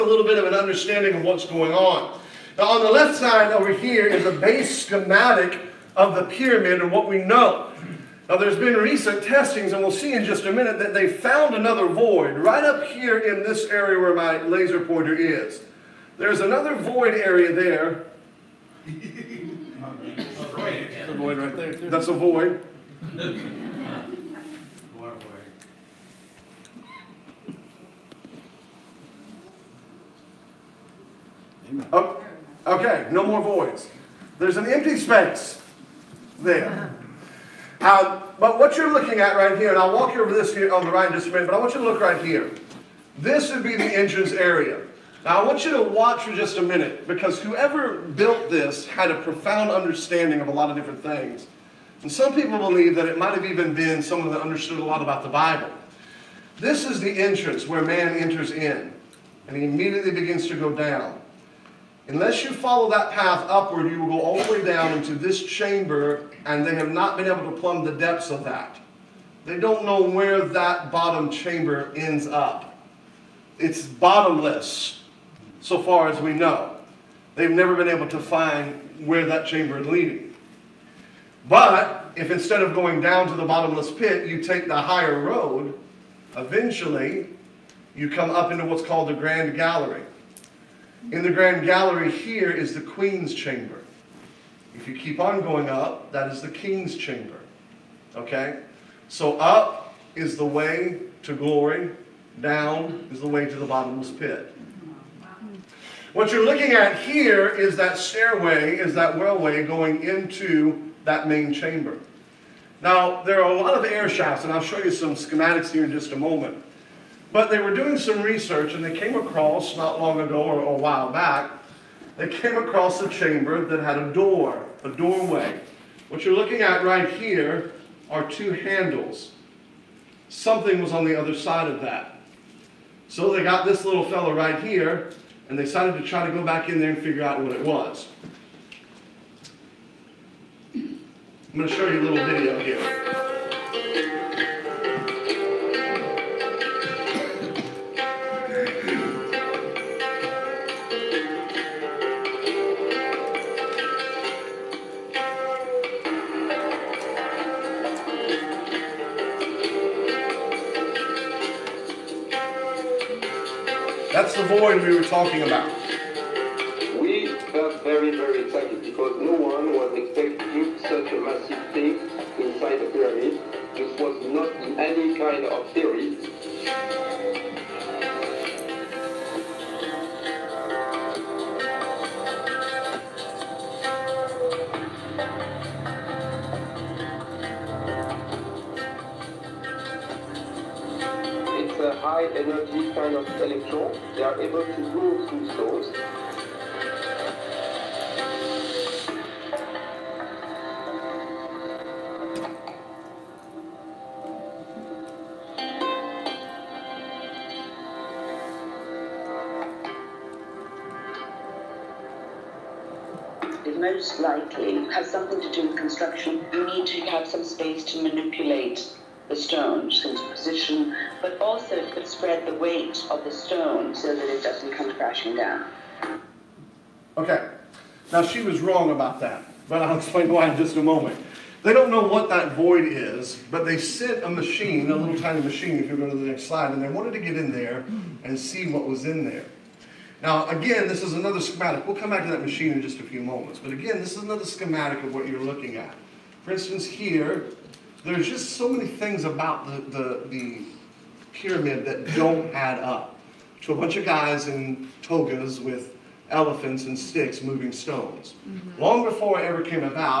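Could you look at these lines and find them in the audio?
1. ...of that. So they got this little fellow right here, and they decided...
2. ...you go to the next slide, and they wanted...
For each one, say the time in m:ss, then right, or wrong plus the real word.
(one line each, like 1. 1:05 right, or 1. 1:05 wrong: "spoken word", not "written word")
1. 2:11 right
2. 3:55 right.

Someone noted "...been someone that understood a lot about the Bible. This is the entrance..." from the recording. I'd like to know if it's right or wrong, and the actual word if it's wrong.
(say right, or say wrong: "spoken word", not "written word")
right.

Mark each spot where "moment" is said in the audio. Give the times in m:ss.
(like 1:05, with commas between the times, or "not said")
1:56, 3:50, 4:03.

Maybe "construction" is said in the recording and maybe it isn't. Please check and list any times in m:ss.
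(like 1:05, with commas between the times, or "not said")
3:35.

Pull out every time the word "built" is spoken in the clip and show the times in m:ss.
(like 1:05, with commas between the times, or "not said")
0:47.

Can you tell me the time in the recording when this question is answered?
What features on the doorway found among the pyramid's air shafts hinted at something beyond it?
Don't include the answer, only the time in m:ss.
2:08.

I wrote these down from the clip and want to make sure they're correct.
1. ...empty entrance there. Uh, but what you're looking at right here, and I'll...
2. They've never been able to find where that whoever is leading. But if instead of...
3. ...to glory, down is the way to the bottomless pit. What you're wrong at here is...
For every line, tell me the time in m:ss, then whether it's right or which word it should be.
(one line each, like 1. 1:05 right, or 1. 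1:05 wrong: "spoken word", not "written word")
1. 0:34 wrong: "space", not "entrance"
2. 1:17 wrong: "chamber", not "whoever"
3. 1:41 wrong: "looking", not "wrong".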